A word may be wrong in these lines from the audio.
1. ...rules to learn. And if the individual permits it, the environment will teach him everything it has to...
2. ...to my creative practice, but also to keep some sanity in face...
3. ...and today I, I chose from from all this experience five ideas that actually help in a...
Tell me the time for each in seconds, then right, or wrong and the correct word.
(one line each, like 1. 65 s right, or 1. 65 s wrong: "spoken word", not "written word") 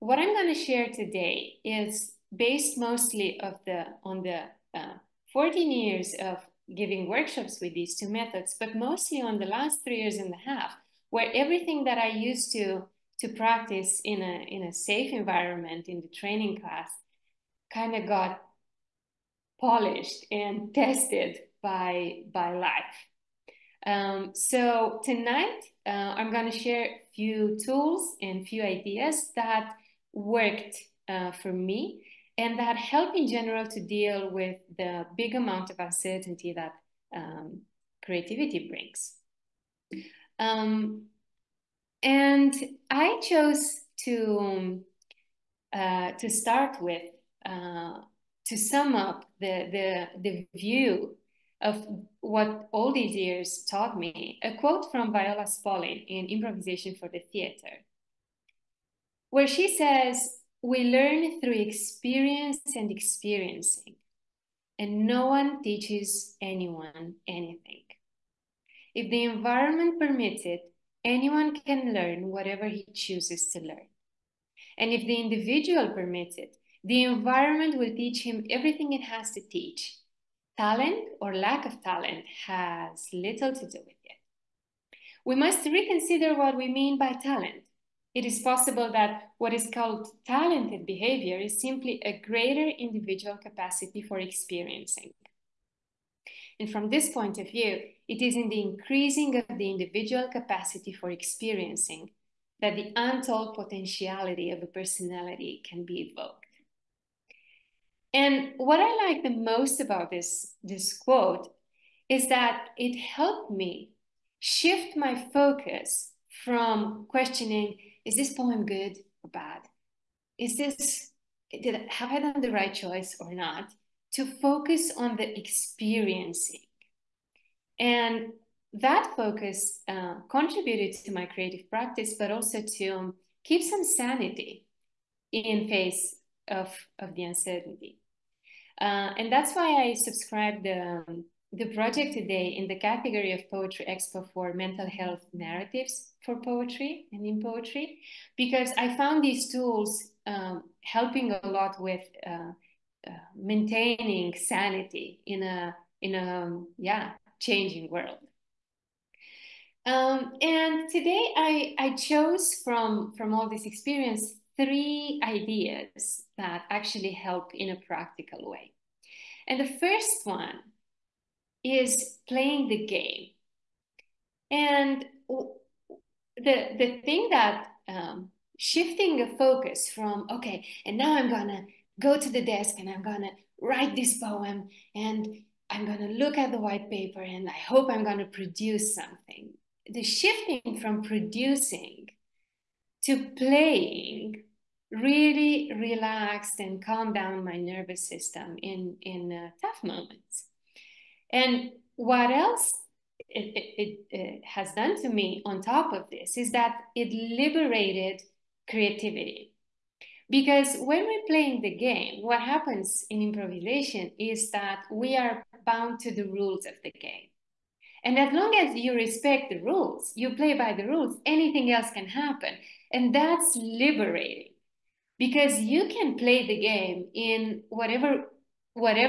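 1. 72 s wrong: "chooses", not "rules"
2. 131 s right
3. 160 s wrong: "three", not "five".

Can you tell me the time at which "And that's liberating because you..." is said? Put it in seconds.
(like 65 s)
222 s.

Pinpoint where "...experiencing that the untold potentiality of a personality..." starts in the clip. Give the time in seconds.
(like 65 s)
101 s.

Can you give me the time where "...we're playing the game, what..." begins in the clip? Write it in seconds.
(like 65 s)
211 s.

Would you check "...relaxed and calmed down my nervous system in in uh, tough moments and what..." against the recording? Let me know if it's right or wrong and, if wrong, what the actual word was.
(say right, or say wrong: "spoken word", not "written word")
right.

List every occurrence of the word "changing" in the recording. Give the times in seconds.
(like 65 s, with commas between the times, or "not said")
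157 s.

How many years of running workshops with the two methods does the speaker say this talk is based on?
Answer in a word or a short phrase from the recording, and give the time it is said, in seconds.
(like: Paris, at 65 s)
14, at 5 s.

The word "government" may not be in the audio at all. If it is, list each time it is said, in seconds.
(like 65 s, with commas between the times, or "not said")
not said.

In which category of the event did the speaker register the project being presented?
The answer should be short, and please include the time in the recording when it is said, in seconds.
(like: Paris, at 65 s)
Poetry Expo, at 143 s.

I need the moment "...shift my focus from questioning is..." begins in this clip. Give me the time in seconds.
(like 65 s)
114 s.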